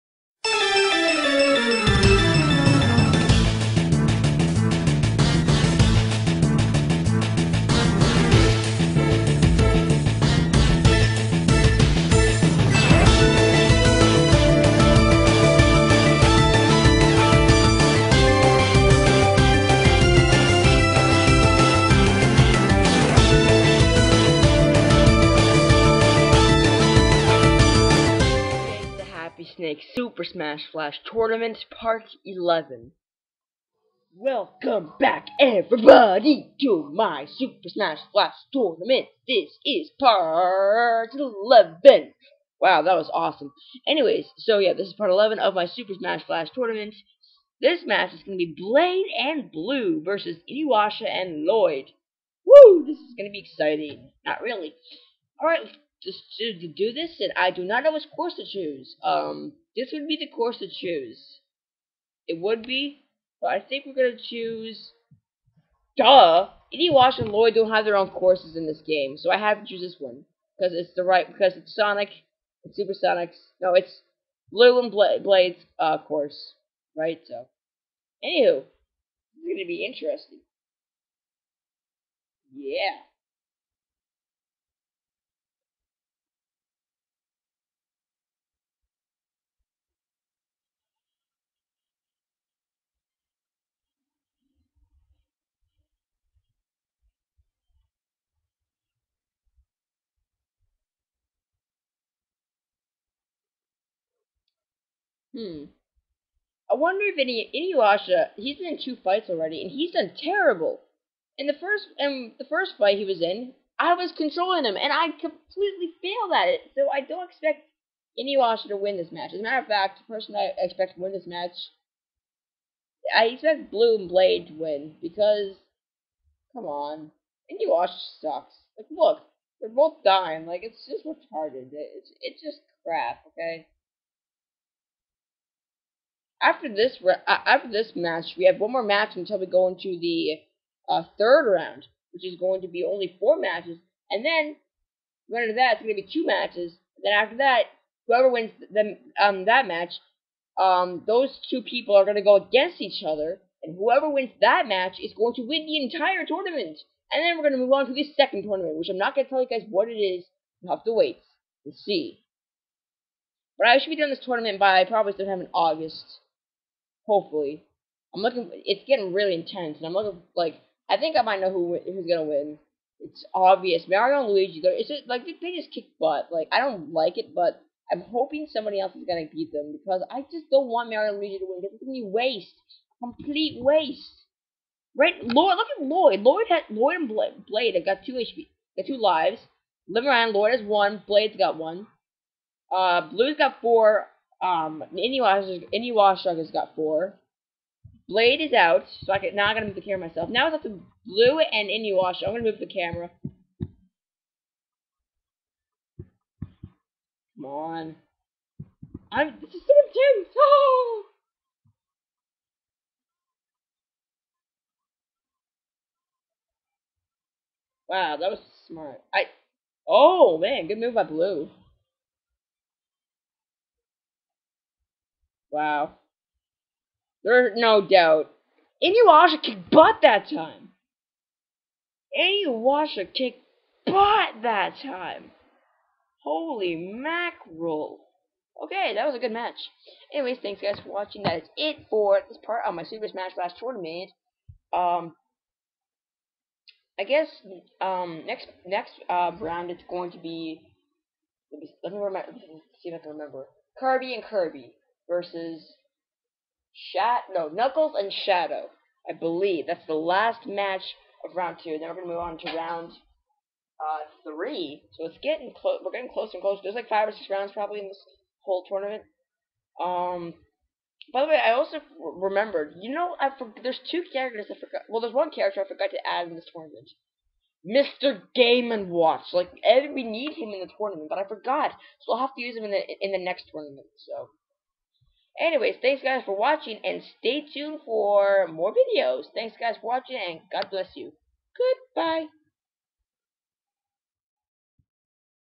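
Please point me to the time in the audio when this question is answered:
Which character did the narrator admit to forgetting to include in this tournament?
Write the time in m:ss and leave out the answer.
4:37.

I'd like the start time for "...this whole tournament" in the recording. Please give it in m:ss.
4:27.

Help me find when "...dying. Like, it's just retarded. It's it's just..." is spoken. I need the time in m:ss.
2:10.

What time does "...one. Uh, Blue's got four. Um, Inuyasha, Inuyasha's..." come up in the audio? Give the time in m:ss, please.
3:11.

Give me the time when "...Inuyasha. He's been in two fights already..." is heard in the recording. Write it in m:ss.
1:47.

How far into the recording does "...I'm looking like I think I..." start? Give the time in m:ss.
2:49.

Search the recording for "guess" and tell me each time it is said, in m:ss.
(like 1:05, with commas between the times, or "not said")
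4:07.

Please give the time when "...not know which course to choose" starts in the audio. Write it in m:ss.
0:57.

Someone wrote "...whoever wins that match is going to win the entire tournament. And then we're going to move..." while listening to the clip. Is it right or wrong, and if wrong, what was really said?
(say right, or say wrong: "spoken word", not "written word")
right.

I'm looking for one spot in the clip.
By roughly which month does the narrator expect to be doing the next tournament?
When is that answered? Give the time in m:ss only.
2:45.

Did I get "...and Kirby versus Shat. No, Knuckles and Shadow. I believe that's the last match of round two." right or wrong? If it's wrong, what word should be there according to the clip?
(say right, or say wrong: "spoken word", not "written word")
right.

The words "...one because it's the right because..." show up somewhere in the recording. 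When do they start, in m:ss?
1:09.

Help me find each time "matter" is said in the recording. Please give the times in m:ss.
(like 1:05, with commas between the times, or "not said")
1:59.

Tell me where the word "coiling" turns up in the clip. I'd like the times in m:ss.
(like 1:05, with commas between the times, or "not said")
not said.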